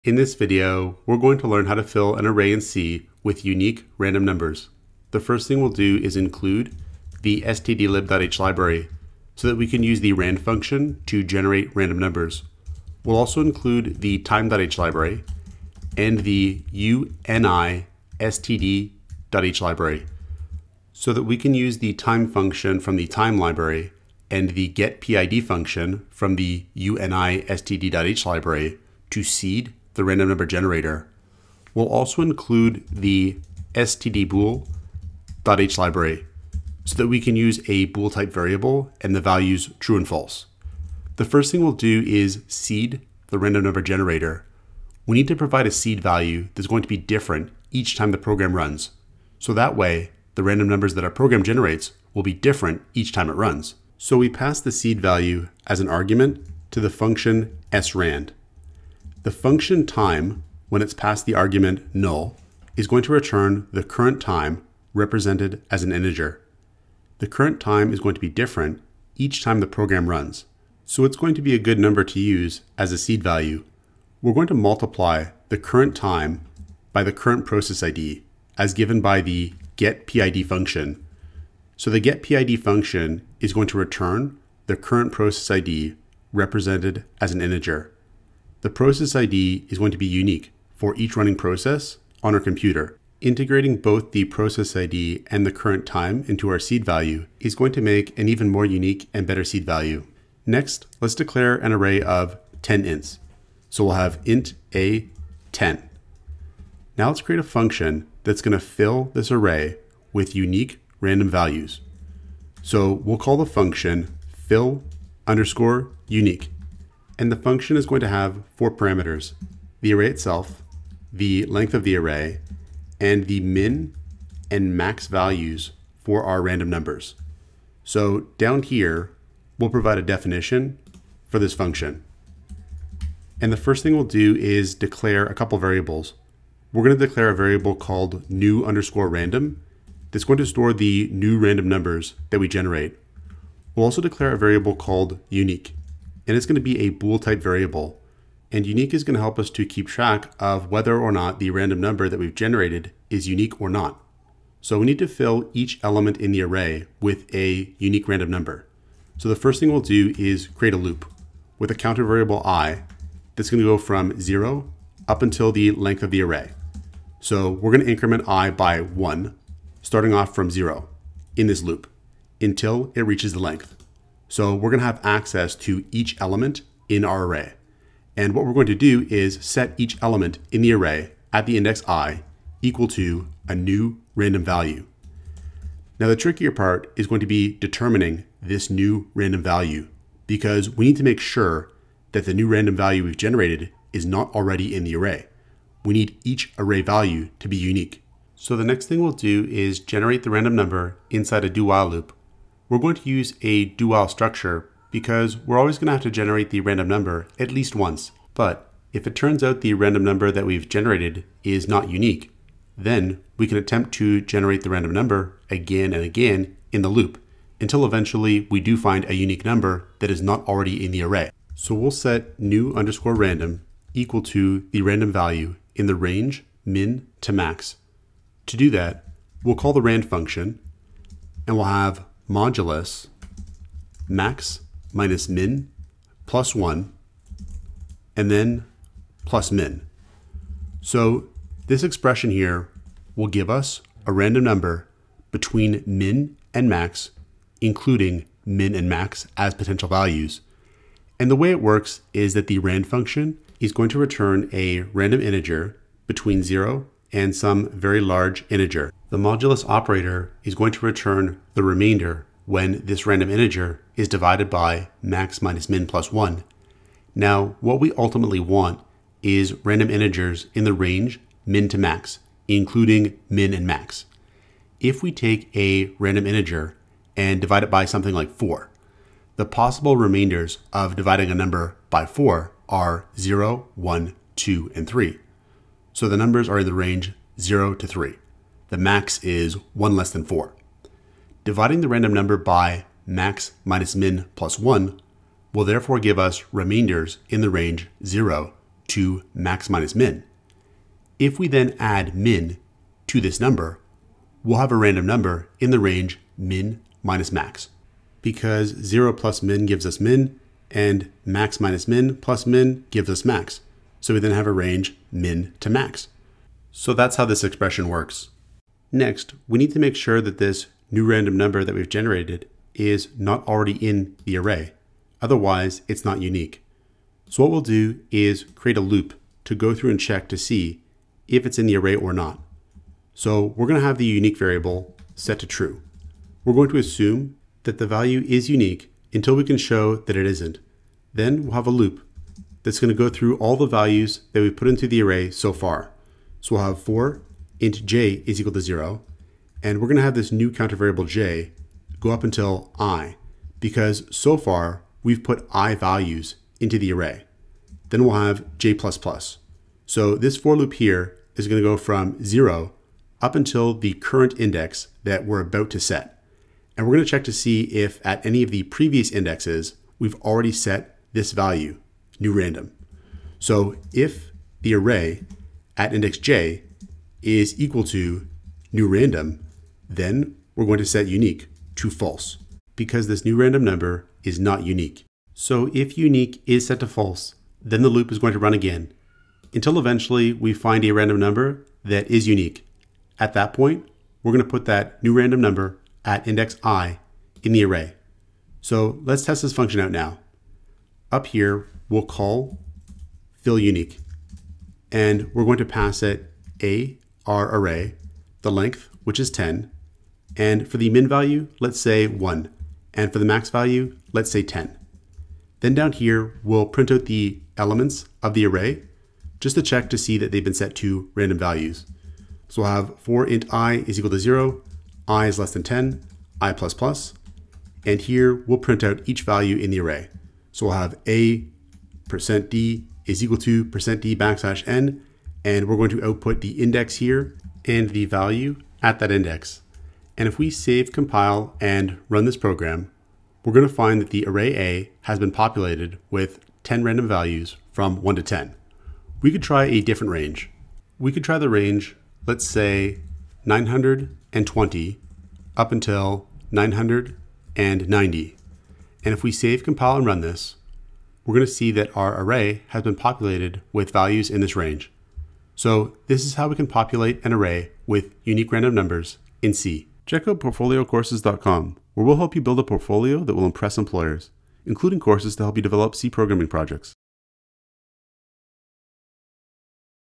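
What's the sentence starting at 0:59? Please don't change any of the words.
The function time, when it's passed the argument null, is going to return the current time represented as an integer.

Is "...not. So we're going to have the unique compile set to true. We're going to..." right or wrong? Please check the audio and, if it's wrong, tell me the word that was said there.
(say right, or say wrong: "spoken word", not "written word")
wrong: "variable", not "compile".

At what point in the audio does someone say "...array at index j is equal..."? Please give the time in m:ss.
6:14.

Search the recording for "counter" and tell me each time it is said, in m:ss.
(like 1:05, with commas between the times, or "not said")
2:41, 5:50.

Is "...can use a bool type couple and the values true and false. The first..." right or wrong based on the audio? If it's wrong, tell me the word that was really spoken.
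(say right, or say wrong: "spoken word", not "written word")
wrong: "variable", not "couple".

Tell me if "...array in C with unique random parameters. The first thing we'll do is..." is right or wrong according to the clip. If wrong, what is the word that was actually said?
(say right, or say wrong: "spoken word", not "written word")
wrong: "numbers", not "parameters".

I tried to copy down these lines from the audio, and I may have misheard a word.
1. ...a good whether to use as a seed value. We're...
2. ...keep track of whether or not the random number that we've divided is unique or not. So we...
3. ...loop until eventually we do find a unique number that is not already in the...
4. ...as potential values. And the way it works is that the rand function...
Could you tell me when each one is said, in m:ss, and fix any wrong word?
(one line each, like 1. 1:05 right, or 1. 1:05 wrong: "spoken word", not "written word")
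1. 1:11 wrong: "number", not "whether"
2. 2:29 wrong: "generated", not "divided"
3. 3:36 right
4. 4:09 right.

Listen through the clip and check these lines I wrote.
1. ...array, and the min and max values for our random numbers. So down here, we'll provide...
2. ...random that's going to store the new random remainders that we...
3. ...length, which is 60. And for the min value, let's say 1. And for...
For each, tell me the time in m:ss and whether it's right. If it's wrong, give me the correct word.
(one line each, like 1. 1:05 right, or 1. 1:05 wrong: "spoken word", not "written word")
1. 2:01 right
2. 2:19 wrong: "numbers", not "remainders"
3. 6:48 wrong: "10", not "60".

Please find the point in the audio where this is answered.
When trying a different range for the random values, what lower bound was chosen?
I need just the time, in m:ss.
7:33.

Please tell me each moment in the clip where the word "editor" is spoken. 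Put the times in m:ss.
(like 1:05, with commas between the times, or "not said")
not said.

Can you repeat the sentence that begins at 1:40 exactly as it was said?
Next, let's declare an array of 10 ints.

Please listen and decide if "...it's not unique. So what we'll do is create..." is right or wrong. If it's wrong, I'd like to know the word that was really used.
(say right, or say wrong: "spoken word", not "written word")
right.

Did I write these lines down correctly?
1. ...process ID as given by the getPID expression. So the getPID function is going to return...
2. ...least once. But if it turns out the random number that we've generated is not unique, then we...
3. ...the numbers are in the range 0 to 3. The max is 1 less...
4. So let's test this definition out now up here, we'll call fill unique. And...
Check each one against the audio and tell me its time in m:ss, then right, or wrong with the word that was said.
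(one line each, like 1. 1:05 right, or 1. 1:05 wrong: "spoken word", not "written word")
1. 1:17 wrong: "function", not "expression"
2. 3:27 right
3. 4:46 right
4. 6:38 wrong: "function", not "definition".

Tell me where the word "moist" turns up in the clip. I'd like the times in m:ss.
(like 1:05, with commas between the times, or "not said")
not said.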